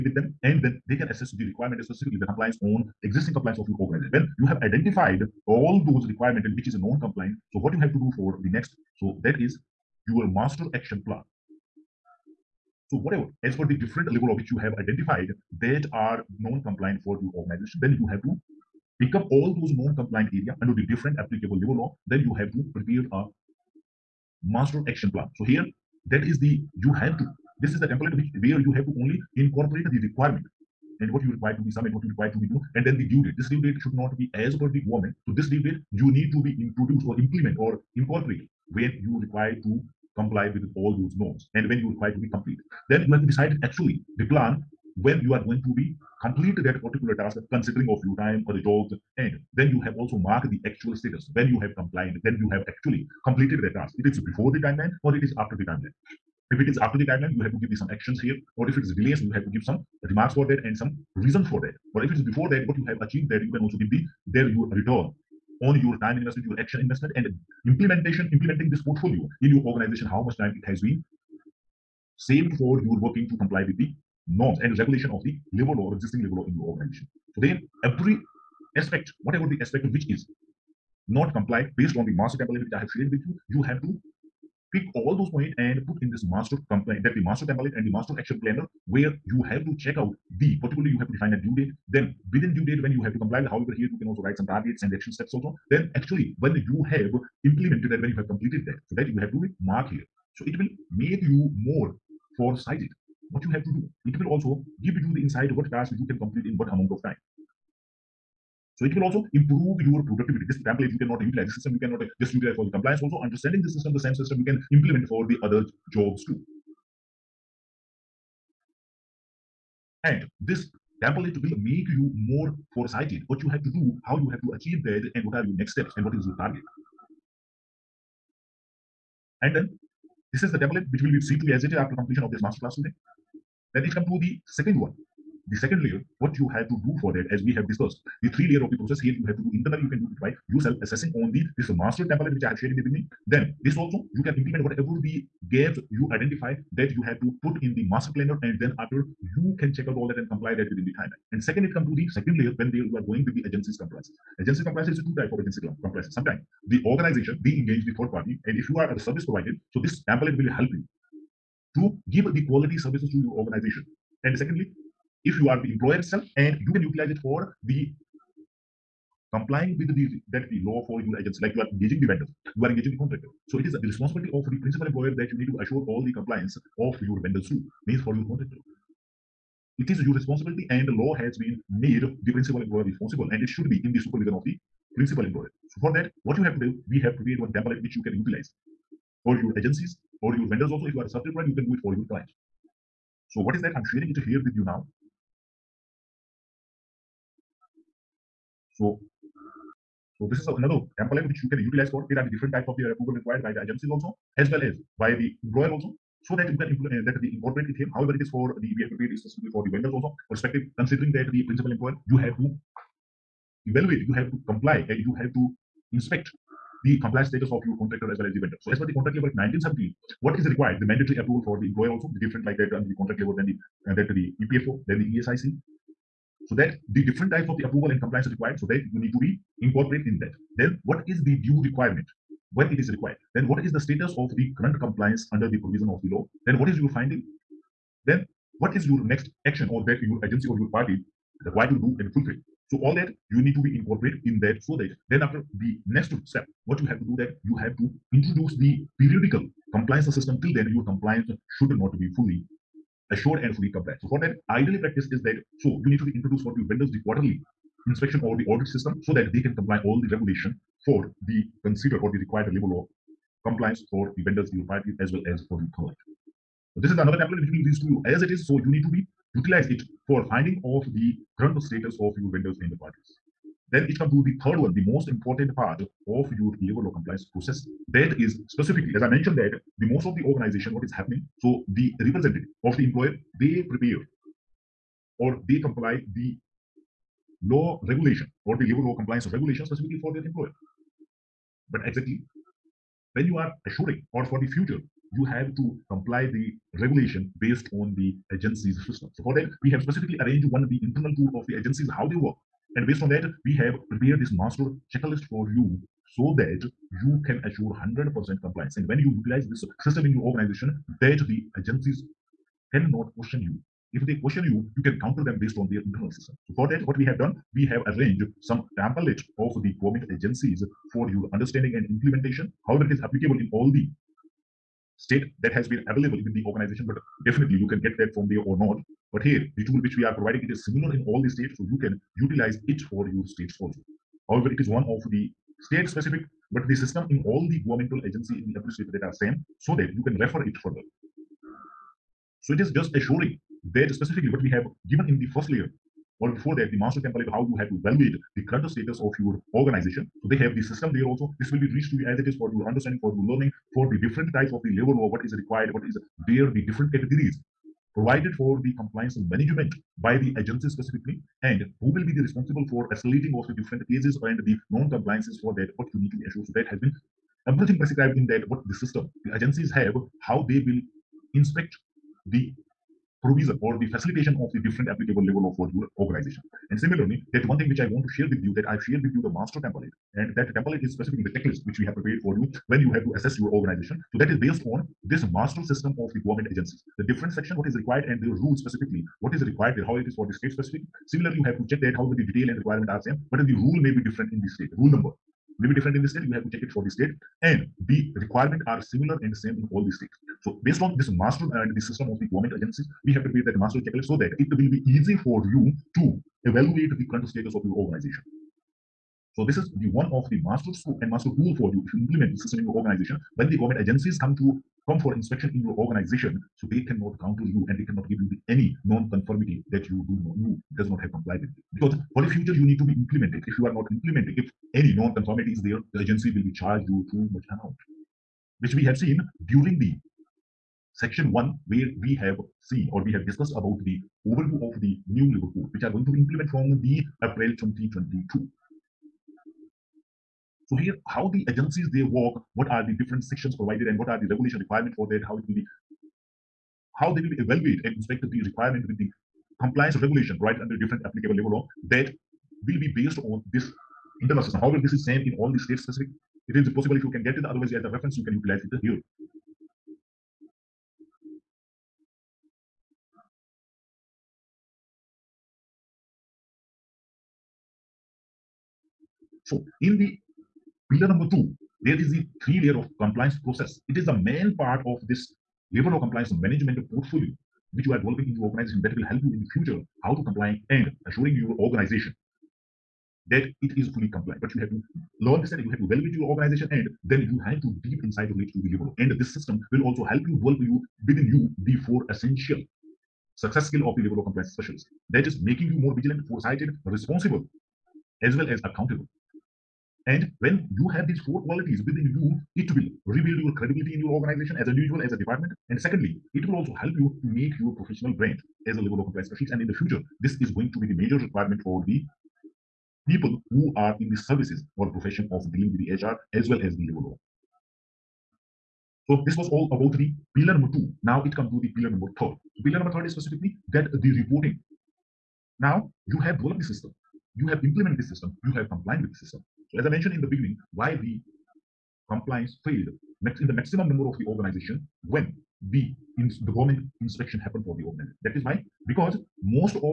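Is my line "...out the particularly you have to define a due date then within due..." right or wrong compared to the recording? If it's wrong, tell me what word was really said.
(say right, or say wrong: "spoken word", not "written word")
right.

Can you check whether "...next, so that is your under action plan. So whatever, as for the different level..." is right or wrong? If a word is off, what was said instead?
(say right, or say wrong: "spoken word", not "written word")
wrong: "master", not "under".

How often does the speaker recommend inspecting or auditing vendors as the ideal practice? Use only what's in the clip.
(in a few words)
Quarterly.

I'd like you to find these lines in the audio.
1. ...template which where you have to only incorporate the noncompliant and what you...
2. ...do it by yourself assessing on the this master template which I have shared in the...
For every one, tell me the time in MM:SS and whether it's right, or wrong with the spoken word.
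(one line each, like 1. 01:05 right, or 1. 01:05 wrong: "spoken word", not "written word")
1. 00:27 wrong: "requirement", not "noncompliant"
2. 02:20 right.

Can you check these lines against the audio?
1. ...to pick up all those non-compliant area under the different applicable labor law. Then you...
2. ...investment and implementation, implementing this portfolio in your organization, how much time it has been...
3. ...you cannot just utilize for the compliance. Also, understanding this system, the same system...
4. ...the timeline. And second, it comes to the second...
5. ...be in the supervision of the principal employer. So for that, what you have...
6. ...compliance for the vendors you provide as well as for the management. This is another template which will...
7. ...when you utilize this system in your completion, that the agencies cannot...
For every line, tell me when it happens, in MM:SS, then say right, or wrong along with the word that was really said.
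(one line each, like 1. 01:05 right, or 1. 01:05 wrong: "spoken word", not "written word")
1. 00:18 right
2. 01:06 right
3. 01:51 right
4. 02:30 right
5. 03:03 right
6. 04:23 wrong: "client", not "management"
7. 05:08 wrong: "organization", not "completion".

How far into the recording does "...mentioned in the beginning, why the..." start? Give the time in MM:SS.
08:49.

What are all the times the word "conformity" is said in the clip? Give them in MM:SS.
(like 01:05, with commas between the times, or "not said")
06:58, 07:04.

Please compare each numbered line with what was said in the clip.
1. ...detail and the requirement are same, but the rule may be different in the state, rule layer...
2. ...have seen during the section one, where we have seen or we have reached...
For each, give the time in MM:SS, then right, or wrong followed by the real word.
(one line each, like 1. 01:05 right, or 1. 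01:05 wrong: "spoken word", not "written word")
1. 06:32 wrong: "number", not "layer"
2. 07:08 wrong: "discussed", not "reached".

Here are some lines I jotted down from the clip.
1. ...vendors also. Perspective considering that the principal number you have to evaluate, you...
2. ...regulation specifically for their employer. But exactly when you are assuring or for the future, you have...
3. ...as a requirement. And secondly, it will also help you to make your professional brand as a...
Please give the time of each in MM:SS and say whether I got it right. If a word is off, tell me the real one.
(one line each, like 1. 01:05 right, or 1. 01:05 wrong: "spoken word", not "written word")
1. 03:29 wrong: "employer", not "number"
2. 04:49 right
3. 08:25 wrong: "department", not "requirement".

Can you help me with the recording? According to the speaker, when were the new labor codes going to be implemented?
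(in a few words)
April 2022.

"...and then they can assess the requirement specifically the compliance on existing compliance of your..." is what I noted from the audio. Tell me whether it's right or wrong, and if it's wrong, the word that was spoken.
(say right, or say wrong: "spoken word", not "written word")
right.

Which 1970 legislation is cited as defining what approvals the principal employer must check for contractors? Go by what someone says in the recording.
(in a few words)
Contract Labor Act.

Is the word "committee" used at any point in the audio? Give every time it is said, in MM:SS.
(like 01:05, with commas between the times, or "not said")
not said.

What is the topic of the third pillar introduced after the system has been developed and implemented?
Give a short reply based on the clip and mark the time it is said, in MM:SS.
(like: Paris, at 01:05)
Reporting, at 08:44.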